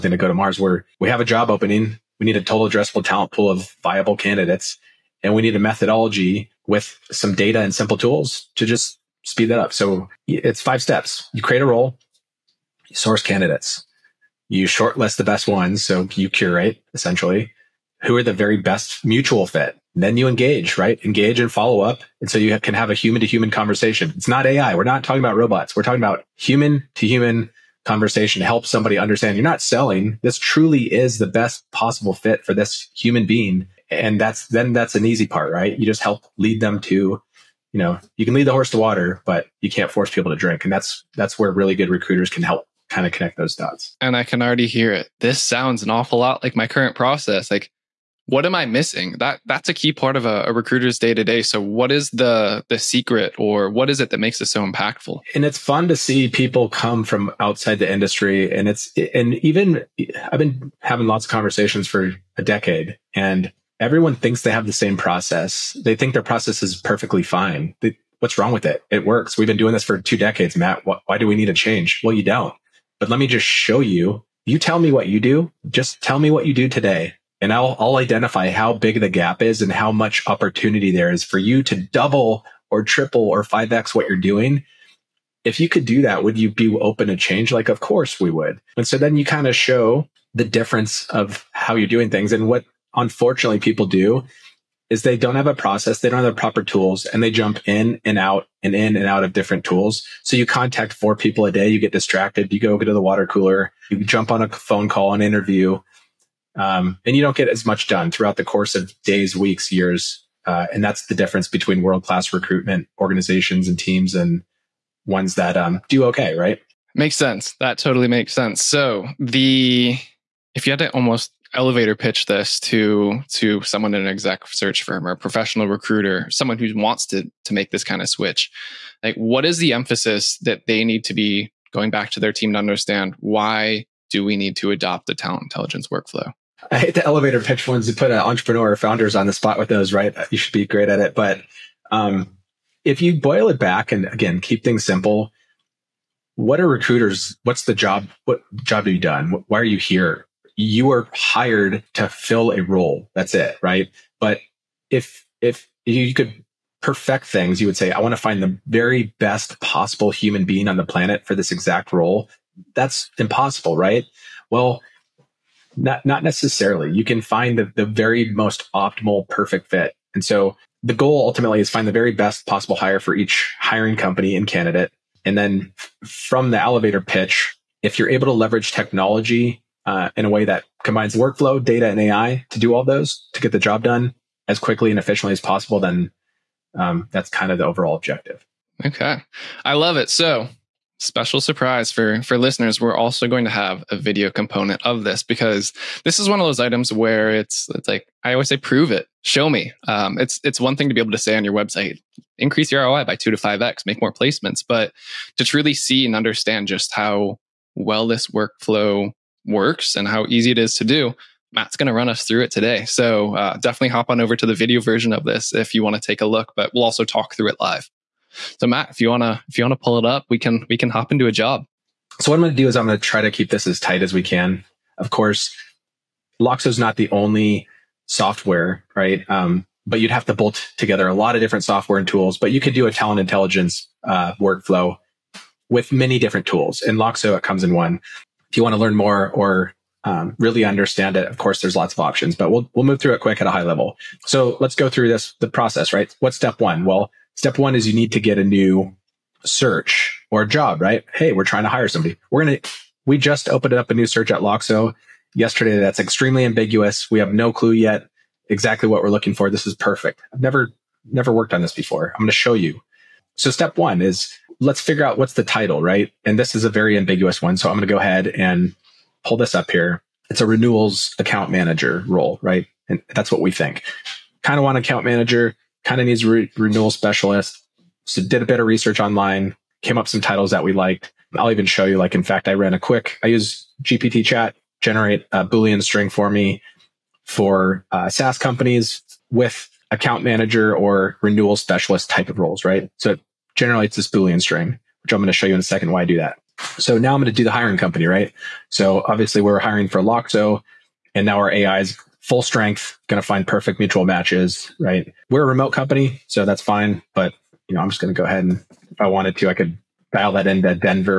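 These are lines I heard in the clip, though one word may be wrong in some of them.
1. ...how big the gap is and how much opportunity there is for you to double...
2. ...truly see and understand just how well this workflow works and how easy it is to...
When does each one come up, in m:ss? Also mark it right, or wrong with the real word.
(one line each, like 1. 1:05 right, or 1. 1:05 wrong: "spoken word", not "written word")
1. 1:18 right
2. 3:25 right.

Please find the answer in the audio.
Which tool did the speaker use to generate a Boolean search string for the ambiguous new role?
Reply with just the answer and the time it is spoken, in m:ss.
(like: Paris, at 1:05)
GPT chat, at 4:43.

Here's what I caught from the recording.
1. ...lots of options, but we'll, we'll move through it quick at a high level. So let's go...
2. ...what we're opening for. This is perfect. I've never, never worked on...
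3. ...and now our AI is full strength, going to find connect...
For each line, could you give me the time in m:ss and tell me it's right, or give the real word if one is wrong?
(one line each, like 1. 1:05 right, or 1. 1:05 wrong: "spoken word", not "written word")
1. 4:01 right
2. 4:18 wrong: "looking", not "opening"
3. 5:01 wrong: "perfect", not "connect".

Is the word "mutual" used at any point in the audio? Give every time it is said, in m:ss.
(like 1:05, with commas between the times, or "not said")
0:19, 5:03.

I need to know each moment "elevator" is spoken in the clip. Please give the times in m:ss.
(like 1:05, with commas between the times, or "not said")
2:01, 2:17, 2:56.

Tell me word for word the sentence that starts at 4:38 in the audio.
So did a bit of research online, came up some titles that we liked.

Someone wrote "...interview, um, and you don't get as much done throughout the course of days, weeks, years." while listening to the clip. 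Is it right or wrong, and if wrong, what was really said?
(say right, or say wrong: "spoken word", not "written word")
right.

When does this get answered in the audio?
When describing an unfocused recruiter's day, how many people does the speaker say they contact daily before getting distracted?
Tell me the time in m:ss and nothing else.
1:40.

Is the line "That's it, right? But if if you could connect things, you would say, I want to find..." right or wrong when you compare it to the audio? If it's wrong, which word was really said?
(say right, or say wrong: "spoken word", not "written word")
wrong: "perfect", not "connect".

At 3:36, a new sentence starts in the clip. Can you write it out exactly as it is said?
But we'll also talk through it live.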